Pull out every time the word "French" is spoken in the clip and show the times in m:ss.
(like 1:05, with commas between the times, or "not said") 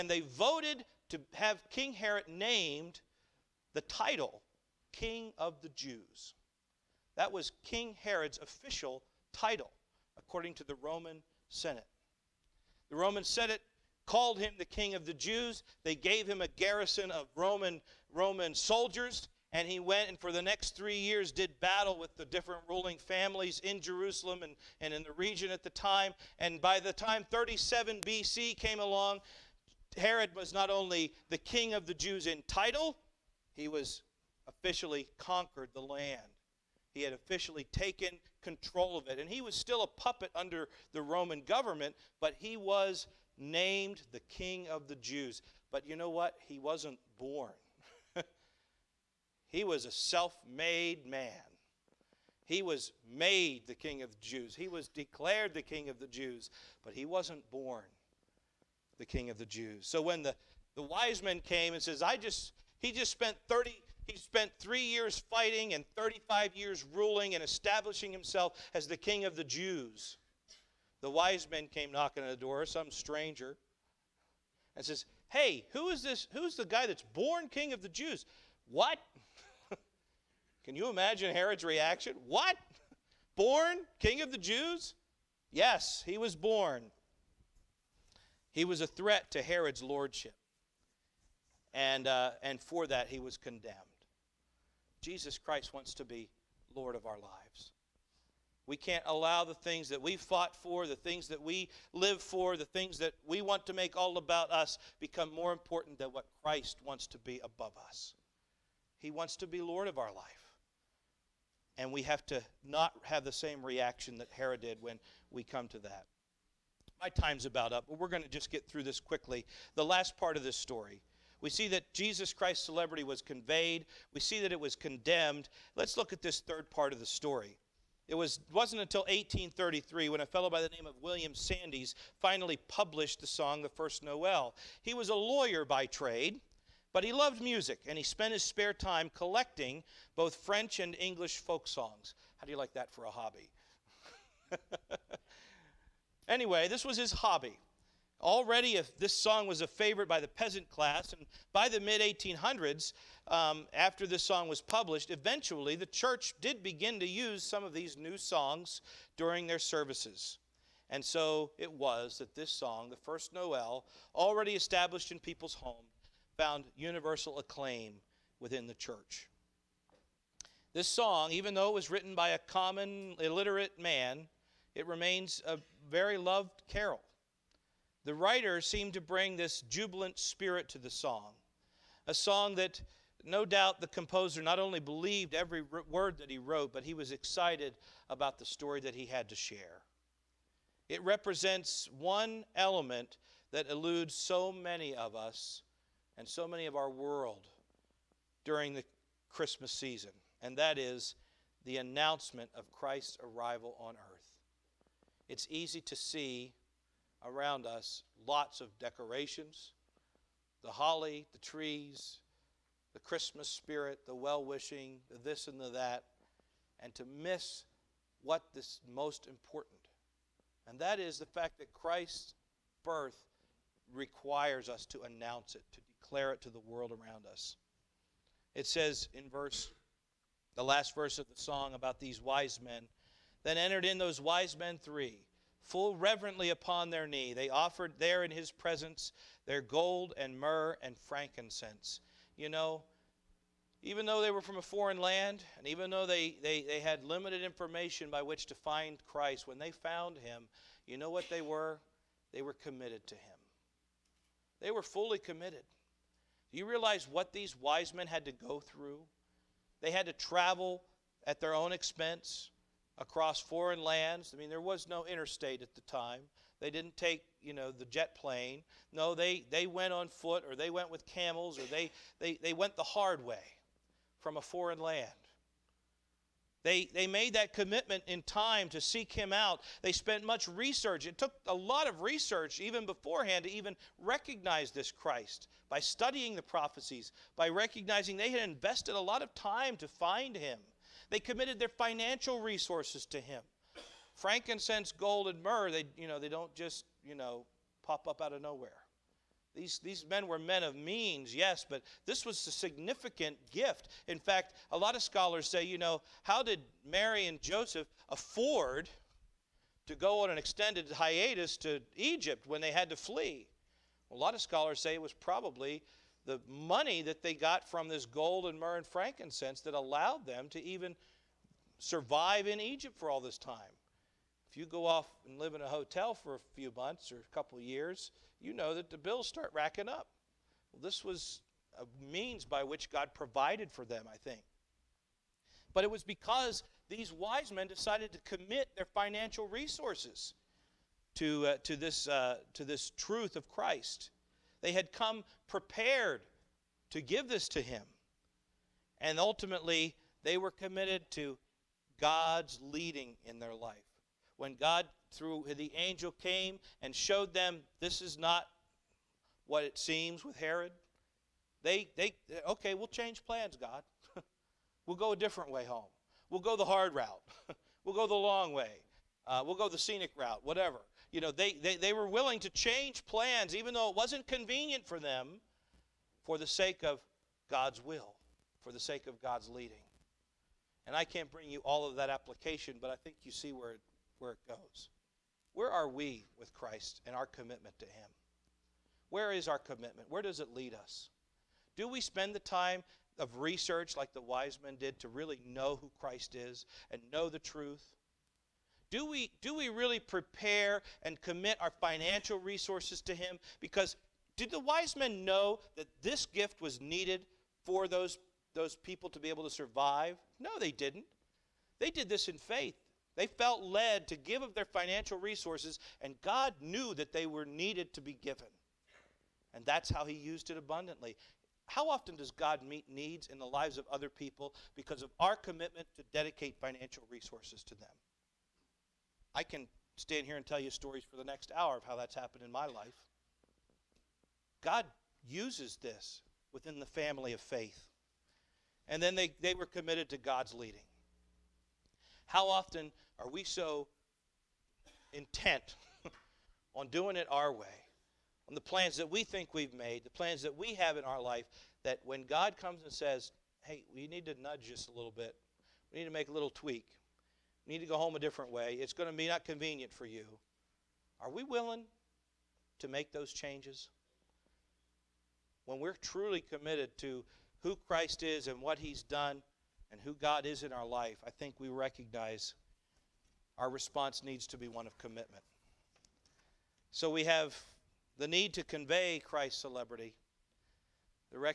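2:20.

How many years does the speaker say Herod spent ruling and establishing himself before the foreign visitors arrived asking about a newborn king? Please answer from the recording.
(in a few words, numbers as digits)
35 years.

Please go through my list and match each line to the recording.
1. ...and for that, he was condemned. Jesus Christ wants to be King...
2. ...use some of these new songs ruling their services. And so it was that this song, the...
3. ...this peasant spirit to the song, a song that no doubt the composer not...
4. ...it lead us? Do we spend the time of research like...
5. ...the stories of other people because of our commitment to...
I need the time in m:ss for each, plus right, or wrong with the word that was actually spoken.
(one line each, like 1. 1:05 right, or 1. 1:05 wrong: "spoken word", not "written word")
1. 1:32 wrong: "Lord", not "King"
2. 2:37 wrong: "during", not "ruling"
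3. 2:59 wrong: "jubilant", not "peasant"
4. 6:30 right
5. 7:03 wrong: "lives", not "stories".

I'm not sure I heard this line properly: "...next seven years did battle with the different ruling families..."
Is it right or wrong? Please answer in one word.
wrong.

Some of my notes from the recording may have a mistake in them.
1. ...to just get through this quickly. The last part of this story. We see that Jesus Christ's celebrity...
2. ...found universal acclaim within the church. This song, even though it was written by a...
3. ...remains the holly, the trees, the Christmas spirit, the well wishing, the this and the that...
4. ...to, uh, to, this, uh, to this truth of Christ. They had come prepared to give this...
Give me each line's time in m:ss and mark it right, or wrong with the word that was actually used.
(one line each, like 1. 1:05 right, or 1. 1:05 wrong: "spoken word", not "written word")
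1. 1:58 right
2. 2:46 right
3. 3:28 wrong: "decorations", not "remains"
4. 5:41 right.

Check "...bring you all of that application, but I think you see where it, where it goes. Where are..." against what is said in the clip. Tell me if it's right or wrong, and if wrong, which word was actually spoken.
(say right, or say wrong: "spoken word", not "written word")
right.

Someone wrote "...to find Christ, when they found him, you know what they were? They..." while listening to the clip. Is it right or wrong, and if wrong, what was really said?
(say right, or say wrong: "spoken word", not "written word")
right.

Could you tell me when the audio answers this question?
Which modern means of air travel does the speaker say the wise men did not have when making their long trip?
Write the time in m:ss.
4:27.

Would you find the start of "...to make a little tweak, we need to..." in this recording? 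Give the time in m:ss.
7:36.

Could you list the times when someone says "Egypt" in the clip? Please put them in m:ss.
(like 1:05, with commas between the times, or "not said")
5:11, 5:22.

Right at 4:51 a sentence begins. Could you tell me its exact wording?
They committed their financial resources to him.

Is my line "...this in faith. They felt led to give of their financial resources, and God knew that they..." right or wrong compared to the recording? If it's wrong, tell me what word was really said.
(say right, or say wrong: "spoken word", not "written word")
right.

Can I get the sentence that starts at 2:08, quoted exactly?
It was, wasn't until 1833 when a fellow by the name of William Sandys finally published the song, The First Noel.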